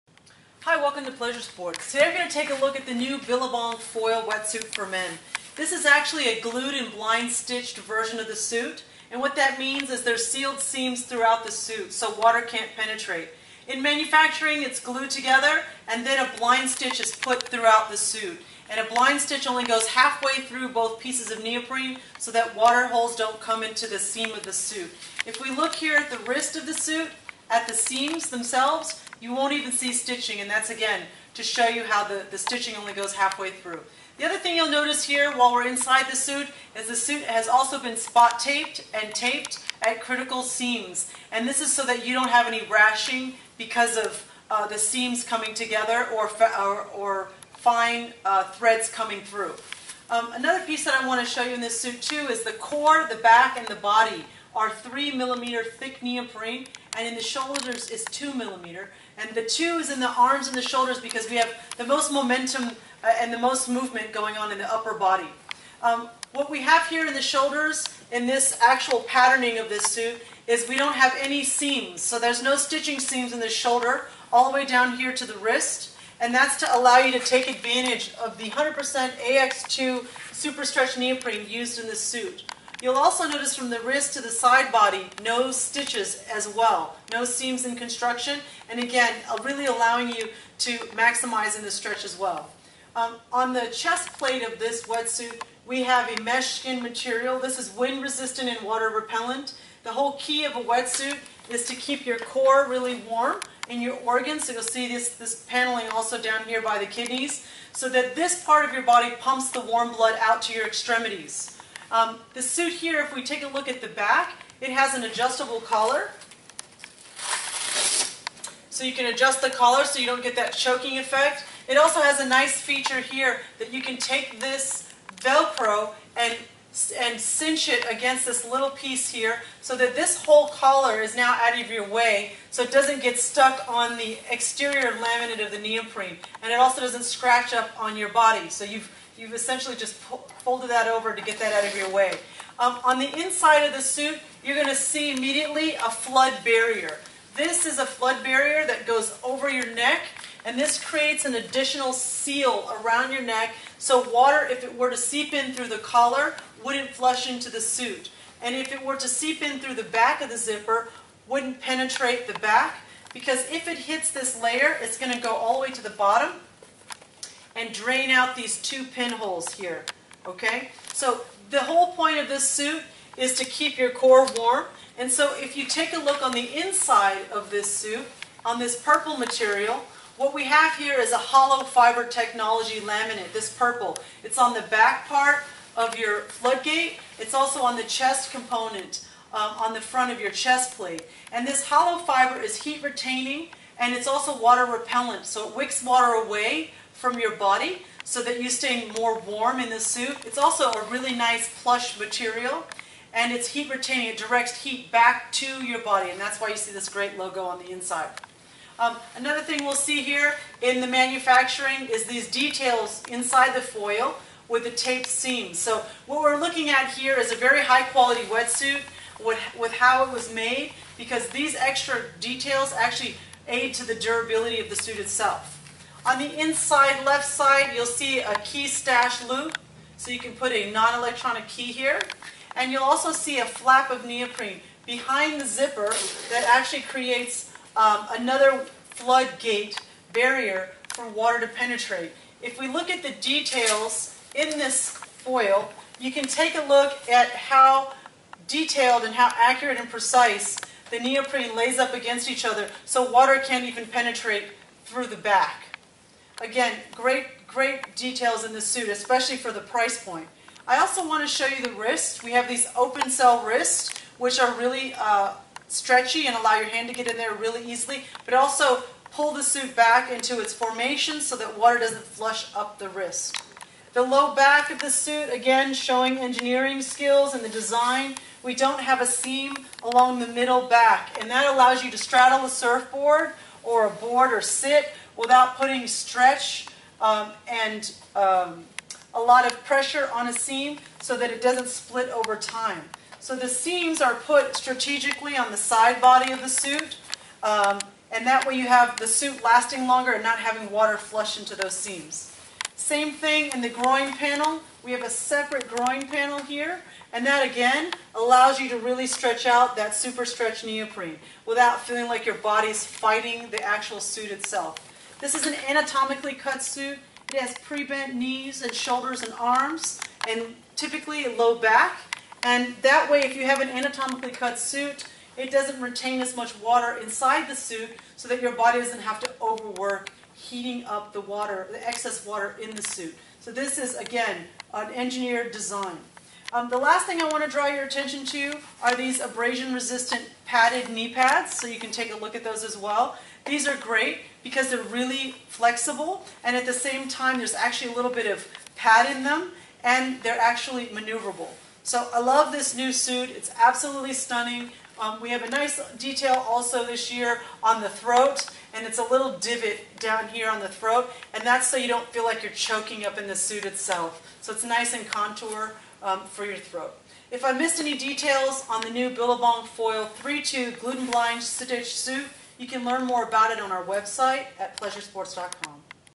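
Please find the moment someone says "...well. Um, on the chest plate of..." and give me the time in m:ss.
1:32.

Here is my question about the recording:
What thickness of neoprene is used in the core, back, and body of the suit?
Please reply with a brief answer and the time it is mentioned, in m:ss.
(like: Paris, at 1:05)
3 millimeter, at 0:54.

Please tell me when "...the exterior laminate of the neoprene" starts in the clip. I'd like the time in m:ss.
2:13.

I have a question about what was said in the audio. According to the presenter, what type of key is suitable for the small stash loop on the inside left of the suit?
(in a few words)
Non-electronic key.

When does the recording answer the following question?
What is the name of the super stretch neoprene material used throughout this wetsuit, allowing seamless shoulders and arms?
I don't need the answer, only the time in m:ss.
1:19.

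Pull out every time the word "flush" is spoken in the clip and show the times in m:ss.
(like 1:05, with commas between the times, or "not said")
2:36, 4:32, 5:00.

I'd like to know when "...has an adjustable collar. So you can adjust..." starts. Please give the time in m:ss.
1:54.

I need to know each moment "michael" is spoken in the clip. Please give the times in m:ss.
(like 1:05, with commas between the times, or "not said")
not said.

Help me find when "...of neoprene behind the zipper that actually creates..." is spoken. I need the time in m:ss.
3:53.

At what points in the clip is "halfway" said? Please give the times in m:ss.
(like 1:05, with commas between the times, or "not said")
0:19, 0:33.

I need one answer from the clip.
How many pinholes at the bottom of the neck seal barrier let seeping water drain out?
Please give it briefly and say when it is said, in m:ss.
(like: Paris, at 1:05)
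2, at 2:48.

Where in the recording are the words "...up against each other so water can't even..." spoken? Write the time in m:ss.
4:11.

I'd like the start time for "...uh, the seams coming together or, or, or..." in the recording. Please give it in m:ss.
0:44.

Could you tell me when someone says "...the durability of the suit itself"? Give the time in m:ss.
3:43.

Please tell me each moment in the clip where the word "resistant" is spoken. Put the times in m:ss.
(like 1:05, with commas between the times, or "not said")
1:38, 5:39.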